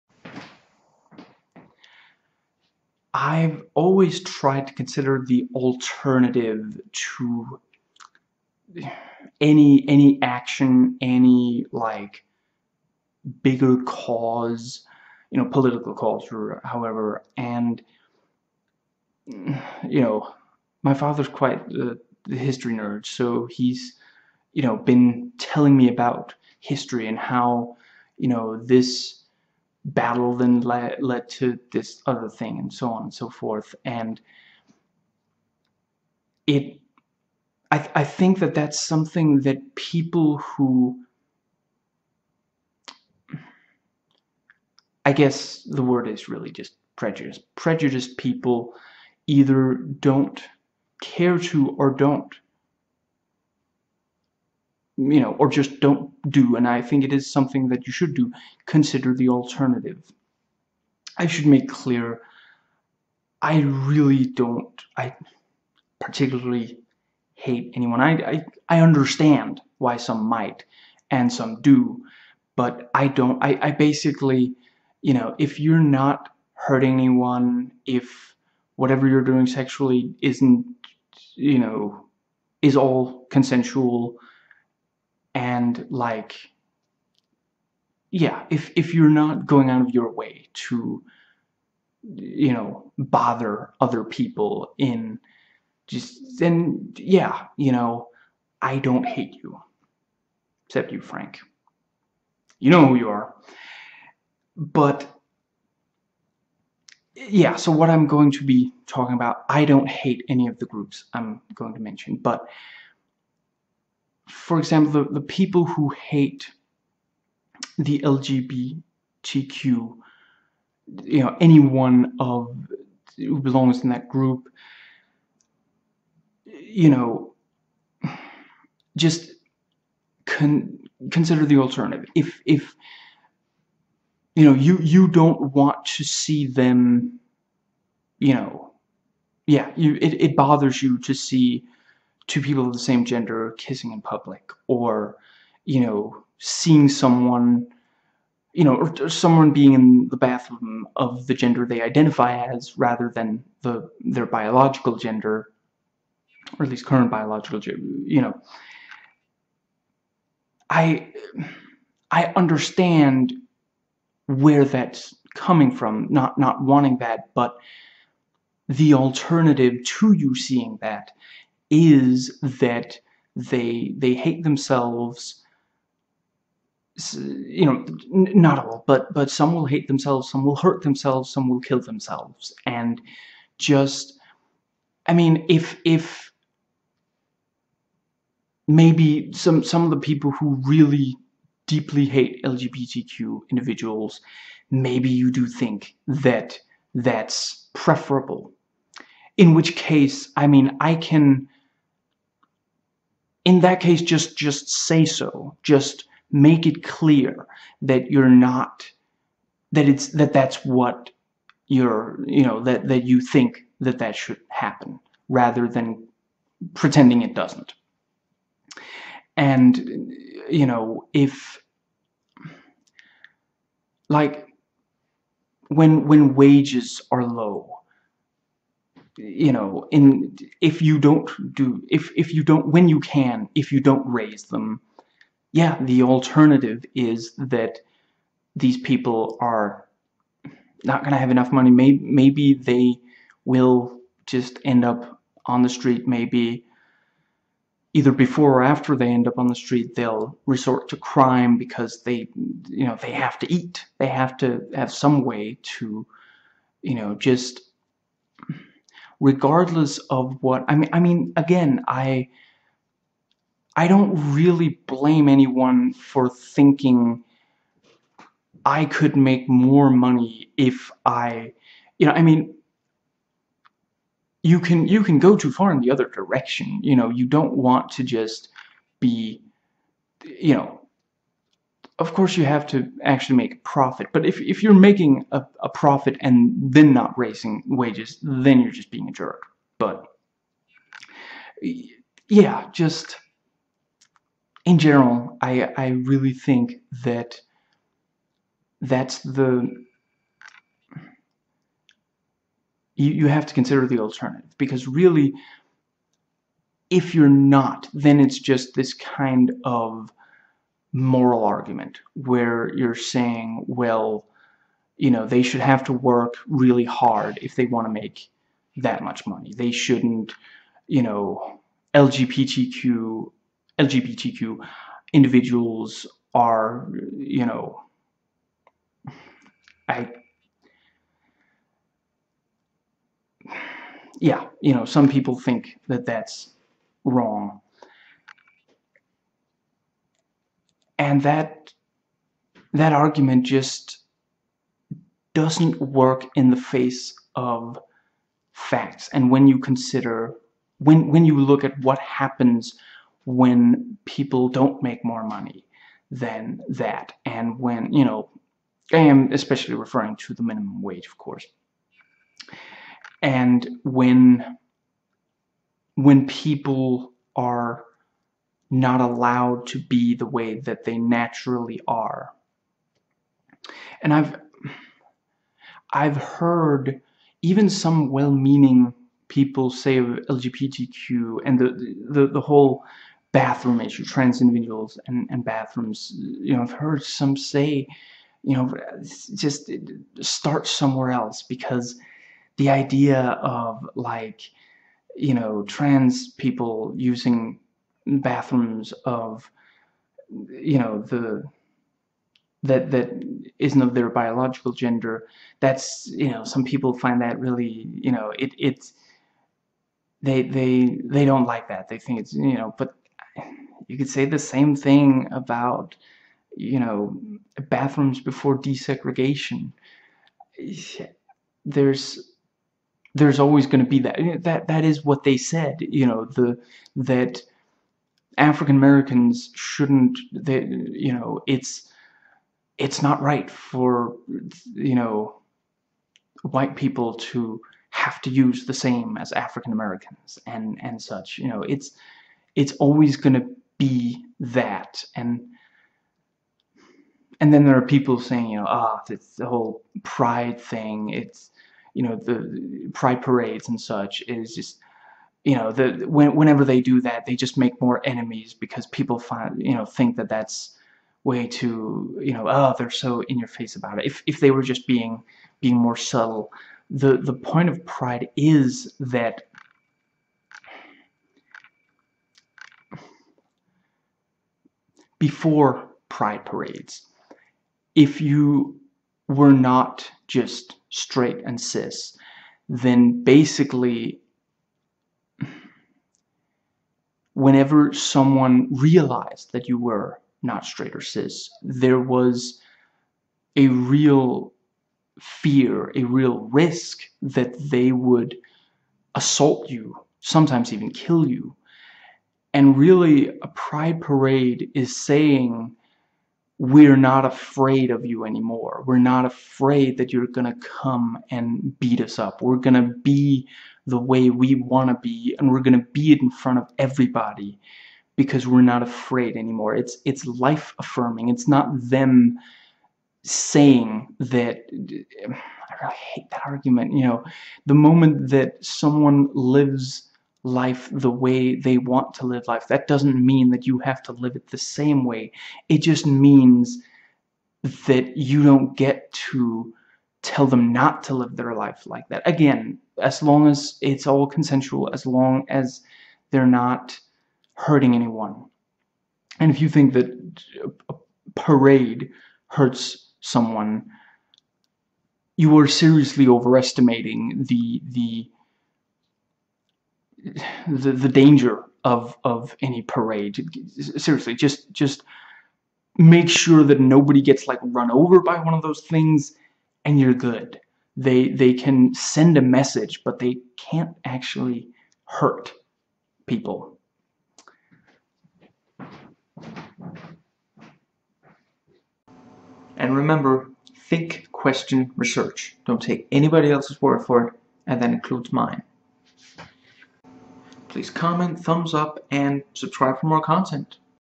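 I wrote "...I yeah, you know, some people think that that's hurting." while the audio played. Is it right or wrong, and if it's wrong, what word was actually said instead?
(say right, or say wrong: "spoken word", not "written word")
wrong: "wrong", not "hurting".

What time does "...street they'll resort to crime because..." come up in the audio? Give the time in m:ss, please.
4:09.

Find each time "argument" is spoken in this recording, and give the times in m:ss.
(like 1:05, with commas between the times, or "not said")
5:11, 5:42, 8:46.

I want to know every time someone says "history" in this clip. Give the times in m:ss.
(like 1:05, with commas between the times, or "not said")
0:22, 0:26.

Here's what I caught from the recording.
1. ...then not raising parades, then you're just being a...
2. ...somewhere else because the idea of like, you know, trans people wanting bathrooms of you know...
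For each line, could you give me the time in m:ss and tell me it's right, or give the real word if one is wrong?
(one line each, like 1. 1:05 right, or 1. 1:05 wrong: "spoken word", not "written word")
1. 4:46 wrong: "wages", not "parades"
2. 6:30 wrong: "using", not "wanting".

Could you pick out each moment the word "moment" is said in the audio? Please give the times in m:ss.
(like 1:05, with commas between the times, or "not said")
8:47.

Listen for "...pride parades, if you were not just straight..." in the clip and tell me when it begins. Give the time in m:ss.
7:56.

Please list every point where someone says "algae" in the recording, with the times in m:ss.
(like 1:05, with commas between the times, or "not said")
not said.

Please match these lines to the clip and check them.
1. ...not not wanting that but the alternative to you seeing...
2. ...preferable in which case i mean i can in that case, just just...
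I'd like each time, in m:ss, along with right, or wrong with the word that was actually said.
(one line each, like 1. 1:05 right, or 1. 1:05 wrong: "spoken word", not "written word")
1. 2:46 right
2. 3:17 right.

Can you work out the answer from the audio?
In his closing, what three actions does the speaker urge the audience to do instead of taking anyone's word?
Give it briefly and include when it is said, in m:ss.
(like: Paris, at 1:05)
Think, question, research, at 9:43.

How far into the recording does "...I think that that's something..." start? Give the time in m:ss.
0:37.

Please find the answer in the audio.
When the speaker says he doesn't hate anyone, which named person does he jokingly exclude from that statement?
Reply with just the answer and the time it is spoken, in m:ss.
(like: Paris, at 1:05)
Frank, at 1:40.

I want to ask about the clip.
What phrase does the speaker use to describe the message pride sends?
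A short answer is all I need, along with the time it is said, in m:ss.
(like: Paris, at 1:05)
Life affirming, at 8:40.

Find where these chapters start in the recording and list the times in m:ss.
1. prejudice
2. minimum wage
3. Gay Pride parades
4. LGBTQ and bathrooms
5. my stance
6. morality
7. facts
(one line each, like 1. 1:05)
1. 1:50
2. 3:45
3. 7:25
4. 6:10
5. 1:00
6. 5:00
7. 5:40.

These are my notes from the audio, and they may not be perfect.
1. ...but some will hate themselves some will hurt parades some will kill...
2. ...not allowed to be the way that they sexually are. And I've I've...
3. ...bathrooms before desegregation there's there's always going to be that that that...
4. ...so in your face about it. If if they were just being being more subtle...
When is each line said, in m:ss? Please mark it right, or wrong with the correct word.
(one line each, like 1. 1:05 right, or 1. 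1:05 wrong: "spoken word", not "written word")
1. 2:59 wrong: "themselves", not "parades"
2. 6:08 wrong: "naturally", not "sexually"
3. 6:57 right
4. 7:42 right.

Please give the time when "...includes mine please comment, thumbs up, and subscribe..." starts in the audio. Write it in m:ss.
9:47.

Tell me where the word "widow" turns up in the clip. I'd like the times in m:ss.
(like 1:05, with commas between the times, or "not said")
not said.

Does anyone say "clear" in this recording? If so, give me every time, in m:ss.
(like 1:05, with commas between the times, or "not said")
1:01, 3:26.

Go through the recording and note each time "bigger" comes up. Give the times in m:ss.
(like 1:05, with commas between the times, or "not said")
0:13.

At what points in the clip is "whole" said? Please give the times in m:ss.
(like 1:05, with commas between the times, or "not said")
6:22, 7:29.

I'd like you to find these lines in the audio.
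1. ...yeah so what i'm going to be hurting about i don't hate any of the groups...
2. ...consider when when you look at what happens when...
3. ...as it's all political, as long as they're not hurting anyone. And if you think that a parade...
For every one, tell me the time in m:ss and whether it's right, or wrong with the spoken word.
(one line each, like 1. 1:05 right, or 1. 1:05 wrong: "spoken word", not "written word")
1. 1:47 wrong: "talking", not "hurting"
2. 5:49 right
3. 9:03 wrong: "consensual", not "political".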